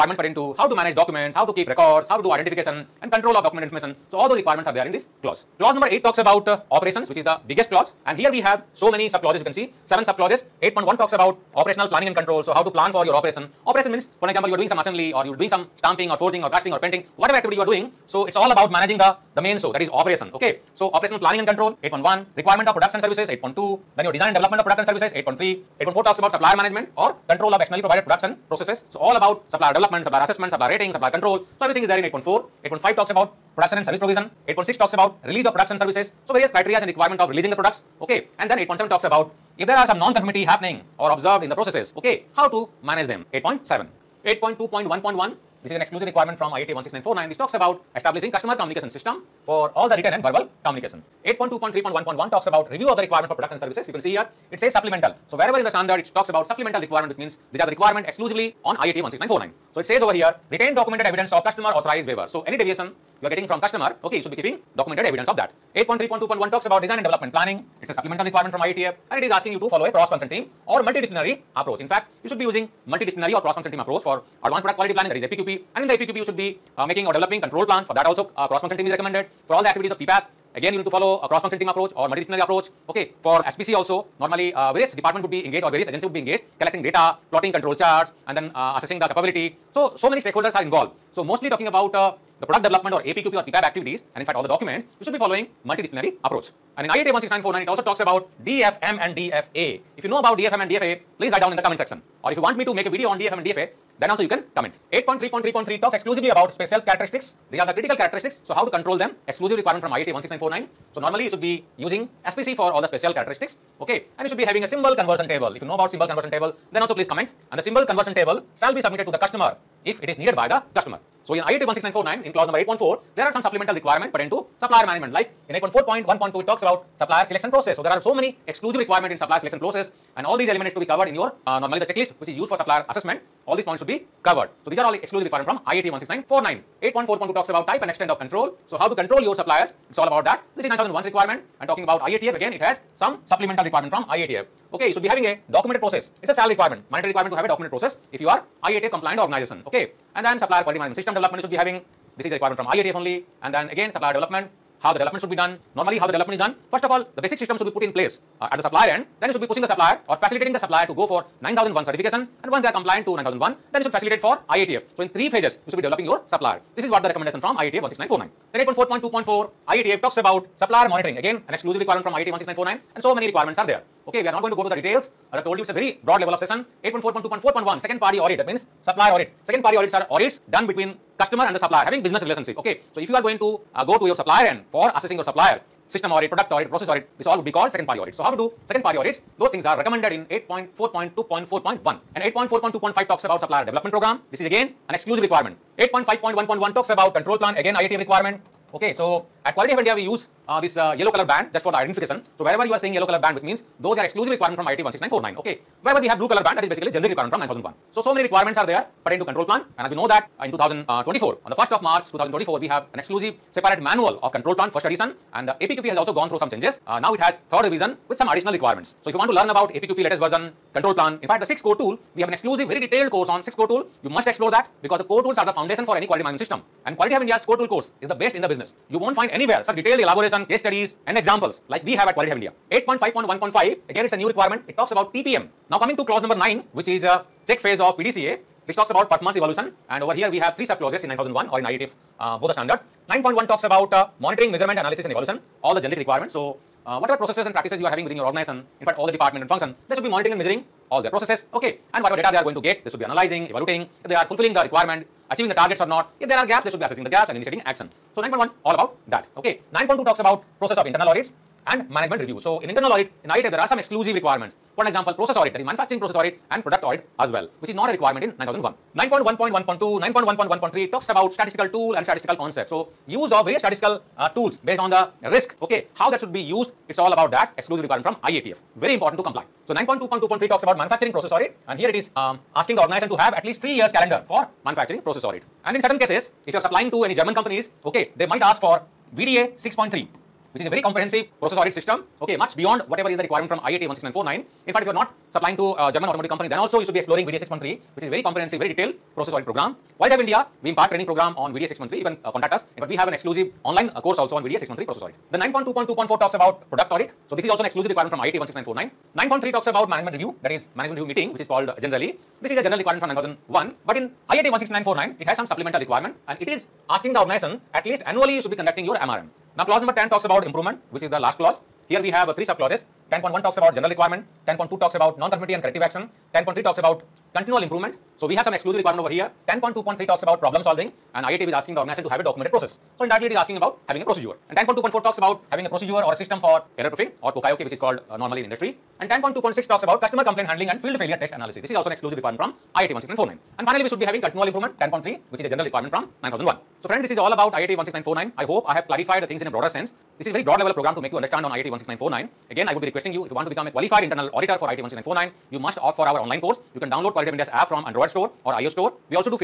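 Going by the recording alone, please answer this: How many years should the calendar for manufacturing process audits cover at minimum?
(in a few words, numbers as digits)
3 years.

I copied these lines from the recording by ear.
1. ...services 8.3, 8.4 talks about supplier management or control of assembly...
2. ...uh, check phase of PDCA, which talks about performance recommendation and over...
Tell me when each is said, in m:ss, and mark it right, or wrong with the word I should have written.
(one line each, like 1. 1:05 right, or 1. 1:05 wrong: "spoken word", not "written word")
1. 0:24 wrong: "externally", not "assembly"
2. 3:57 wrong: "evaluation", not "recommendation".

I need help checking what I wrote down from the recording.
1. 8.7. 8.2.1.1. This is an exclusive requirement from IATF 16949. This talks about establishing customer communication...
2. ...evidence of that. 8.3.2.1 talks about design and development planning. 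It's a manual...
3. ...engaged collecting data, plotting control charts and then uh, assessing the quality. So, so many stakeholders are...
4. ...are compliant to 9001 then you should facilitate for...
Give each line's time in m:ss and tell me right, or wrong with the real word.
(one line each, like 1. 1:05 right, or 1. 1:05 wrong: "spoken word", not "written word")
1. 0:43 right
2. 1:05 wrong: "supplemental", not "manual"
3. 1:26 wrong: "capability", not "quality"
4. 2:42 right.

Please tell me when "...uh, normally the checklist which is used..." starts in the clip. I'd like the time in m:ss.
2:11.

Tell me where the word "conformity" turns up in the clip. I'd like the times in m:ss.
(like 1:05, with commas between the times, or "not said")
0:40, 5:25.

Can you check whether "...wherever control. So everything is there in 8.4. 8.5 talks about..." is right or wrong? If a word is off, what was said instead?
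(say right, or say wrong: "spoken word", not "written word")
wrong: "supplier", not "wherever".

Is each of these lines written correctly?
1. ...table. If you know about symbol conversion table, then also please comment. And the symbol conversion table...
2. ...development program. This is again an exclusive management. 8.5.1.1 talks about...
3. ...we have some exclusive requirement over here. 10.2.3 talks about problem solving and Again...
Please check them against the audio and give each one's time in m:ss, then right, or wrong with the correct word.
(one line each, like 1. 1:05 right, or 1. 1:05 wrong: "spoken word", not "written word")
1. 1:55 right
2. 3:13 wrong: "requirement", not "management"
3. 5:28 wrong: "IATF", not "Again".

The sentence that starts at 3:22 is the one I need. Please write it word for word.
So wherever you are seeing yellow color band, which means those are exclusive requirement from IATF 16949.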